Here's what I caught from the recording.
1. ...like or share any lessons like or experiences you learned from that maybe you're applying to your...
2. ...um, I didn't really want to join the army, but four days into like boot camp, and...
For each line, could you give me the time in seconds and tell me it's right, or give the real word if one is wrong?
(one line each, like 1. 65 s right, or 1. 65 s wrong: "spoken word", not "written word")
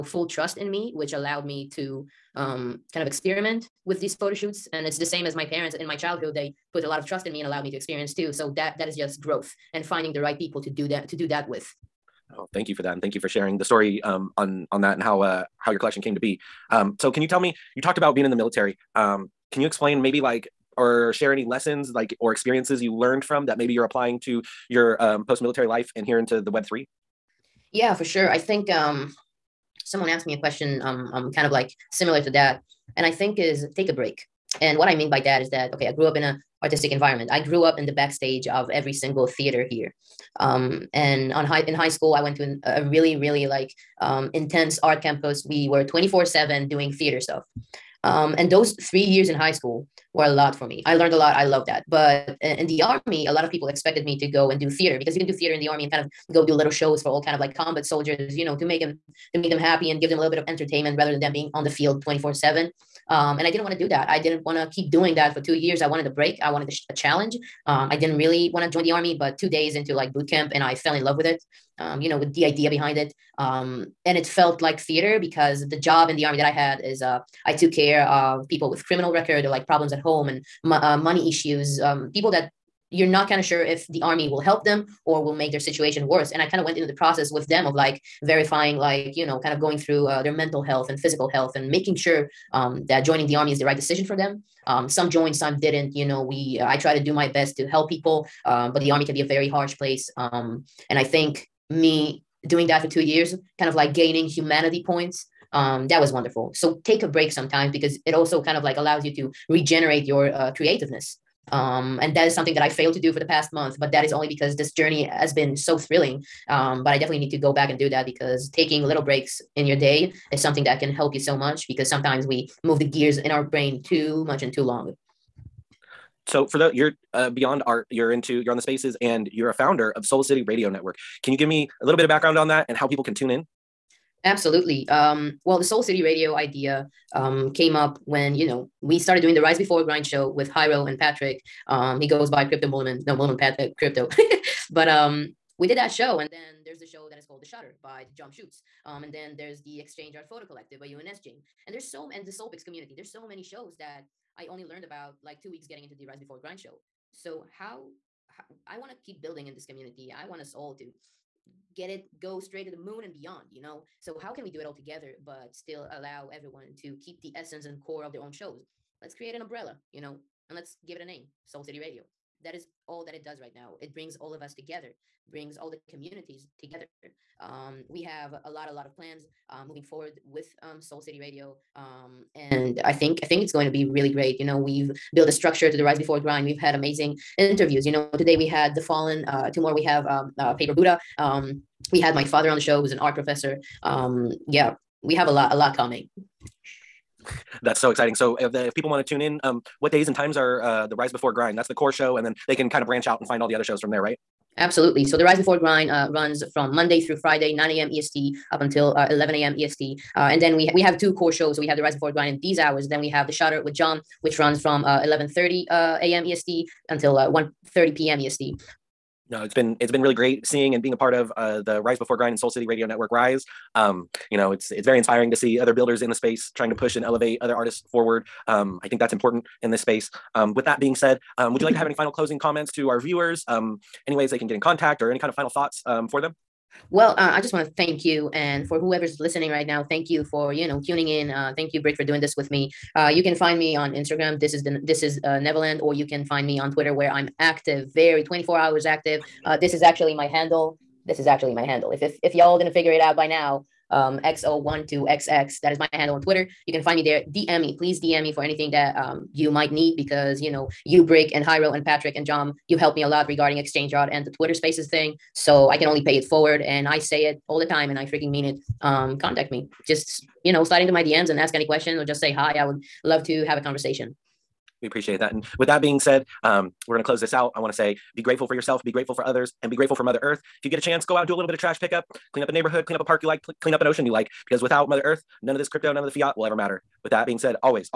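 1. 20 s right
2. 67 s wrong: "two", not "four".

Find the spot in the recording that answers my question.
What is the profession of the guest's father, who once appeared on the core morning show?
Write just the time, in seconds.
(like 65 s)
192 s.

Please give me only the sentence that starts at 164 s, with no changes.
So how can we do it all together, but still allow everyone to keep the essence and core of their own shows?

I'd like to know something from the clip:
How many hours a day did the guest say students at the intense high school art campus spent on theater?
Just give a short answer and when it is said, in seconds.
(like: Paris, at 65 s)
24, at 45 s.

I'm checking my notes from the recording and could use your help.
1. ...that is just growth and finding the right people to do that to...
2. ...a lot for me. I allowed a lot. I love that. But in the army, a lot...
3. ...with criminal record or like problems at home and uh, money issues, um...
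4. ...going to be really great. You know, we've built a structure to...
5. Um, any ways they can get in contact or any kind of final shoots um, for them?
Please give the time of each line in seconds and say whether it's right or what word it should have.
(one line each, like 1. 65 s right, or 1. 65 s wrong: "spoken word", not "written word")
1. 8 s right
2. 50 s wrong: "learned", not "allowed"
3. 78 s right
4. 183 s right
5. 233 s wrong: "thoughts", not "shoots".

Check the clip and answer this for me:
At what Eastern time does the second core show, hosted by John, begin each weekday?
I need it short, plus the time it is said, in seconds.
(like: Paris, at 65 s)
11:30 a.m., at 214 s.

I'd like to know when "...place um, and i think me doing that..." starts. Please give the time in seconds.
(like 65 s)
99 s.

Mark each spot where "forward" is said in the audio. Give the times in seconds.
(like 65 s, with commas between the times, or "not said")
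179 s, 227 s, 266 s.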